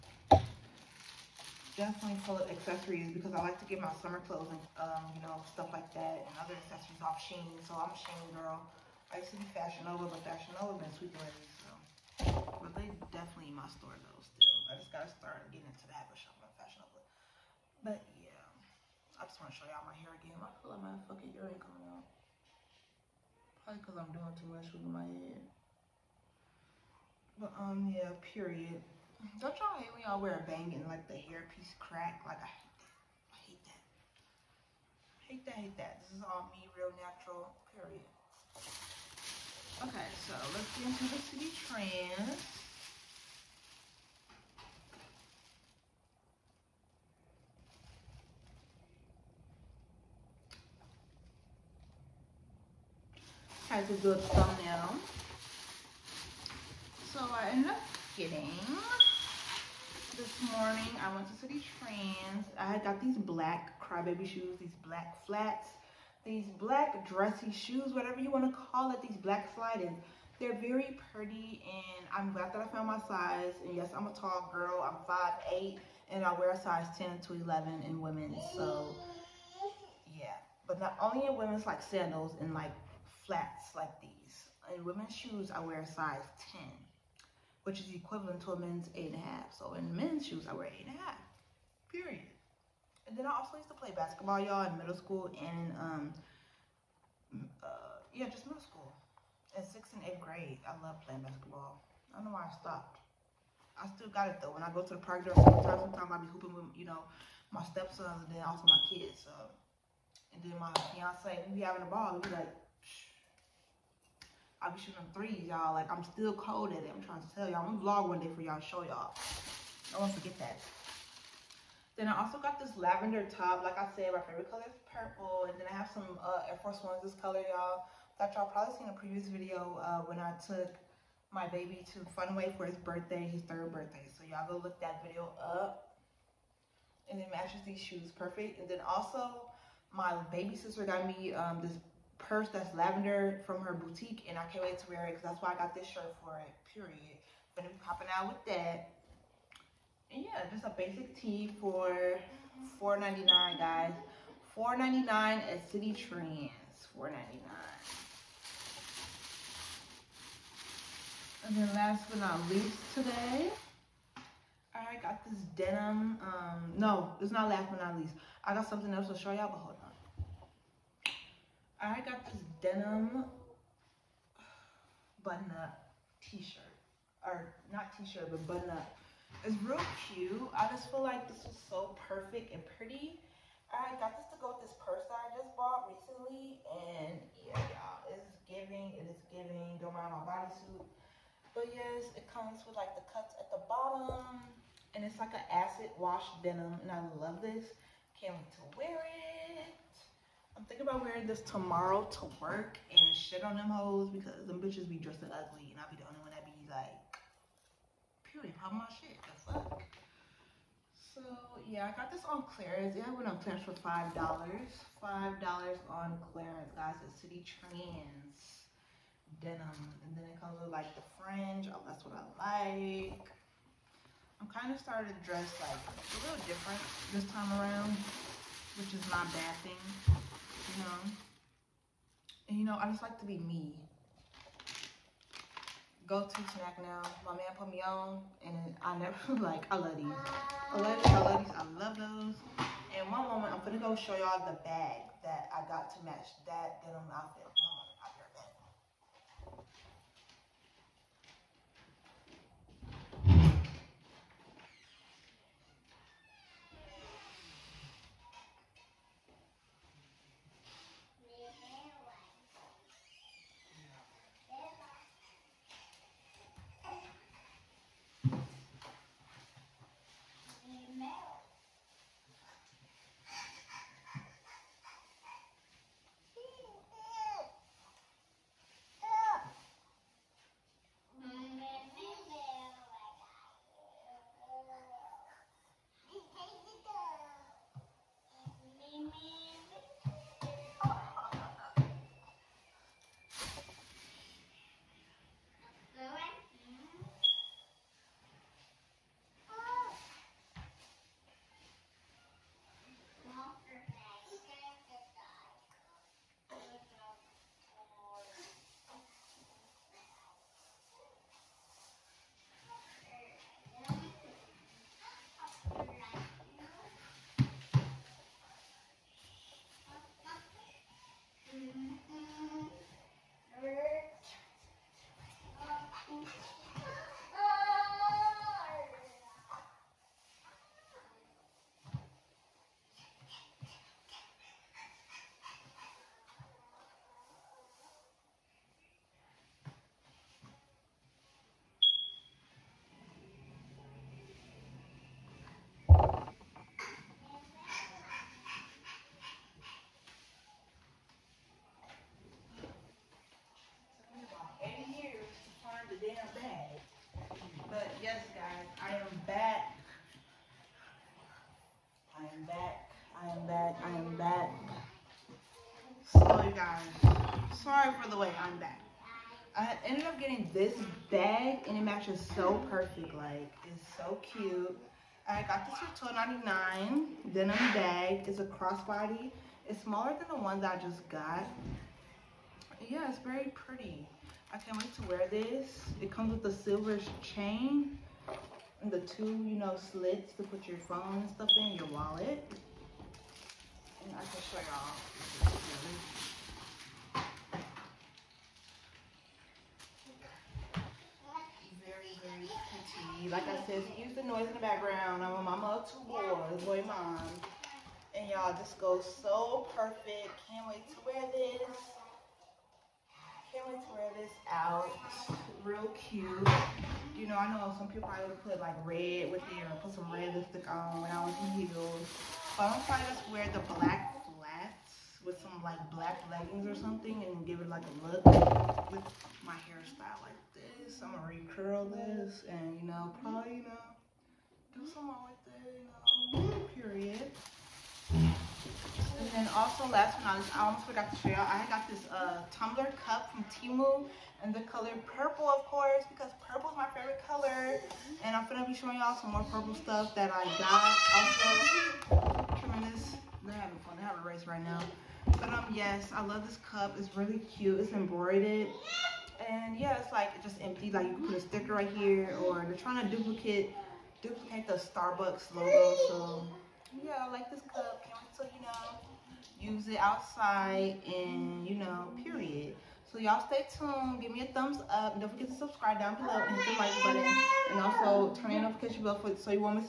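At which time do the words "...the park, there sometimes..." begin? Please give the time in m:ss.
1:44.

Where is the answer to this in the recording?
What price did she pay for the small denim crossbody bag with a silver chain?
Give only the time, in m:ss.
6:16.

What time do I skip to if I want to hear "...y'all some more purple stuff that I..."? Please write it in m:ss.
7:28.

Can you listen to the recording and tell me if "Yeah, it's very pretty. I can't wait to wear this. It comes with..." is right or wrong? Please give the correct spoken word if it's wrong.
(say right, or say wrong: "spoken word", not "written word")
right.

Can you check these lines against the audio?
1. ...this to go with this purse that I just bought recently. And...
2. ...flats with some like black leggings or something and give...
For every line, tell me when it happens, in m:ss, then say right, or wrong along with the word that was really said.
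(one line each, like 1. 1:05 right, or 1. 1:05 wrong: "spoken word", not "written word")
1. 3:04 right
2. 7:04 right.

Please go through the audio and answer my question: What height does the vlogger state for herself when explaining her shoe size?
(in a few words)
5'8.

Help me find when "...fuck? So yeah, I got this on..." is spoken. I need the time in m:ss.
3:29.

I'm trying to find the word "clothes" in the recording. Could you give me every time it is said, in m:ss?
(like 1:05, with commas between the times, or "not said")
0:04.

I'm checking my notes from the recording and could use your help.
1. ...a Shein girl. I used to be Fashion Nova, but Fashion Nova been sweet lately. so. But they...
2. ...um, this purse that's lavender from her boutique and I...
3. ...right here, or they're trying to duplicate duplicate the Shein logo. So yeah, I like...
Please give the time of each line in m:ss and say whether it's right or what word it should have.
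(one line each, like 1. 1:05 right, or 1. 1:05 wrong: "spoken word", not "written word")
1. 0:07 right
2. 2:21 right
3. 7:41 wrong: "Starbucks", not "Shein".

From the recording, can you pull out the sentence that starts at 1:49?
So, and then my fiance, we be having a ball.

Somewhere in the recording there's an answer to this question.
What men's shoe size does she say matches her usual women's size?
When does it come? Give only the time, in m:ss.
1:28.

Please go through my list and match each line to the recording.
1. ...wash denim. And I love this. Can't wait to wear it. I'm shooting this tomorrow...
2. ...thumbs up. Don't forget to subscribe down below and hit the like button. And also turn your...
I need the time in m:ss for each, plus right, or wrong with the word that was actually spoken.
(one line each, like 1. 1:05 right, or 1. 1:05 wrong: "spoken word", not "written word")
1. 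3:15 wrong: "wearing", not "shooting"
2. 7:54 right.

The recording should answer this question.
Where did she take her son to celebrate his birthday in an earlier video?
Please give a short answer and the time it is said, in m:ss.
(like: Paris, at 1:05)
Funway, at 2:12.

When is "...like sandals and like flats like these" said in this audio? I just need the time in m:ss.
1:21.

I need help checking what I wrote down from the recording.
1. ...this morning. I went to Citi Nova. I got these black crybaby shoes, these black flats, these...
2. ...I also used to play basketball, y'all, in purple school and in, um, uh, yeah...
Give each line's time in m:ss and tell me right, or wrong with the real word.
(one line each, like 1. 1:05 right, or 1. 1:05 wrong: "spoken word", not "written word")
1. 1:00 wrong: "Trends", not "Nova"
2. 1:33 wrong: "middle", not "purple".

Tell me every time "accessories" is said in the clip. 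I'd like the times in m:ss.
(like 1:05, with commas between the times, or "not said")
0:02, 0:06.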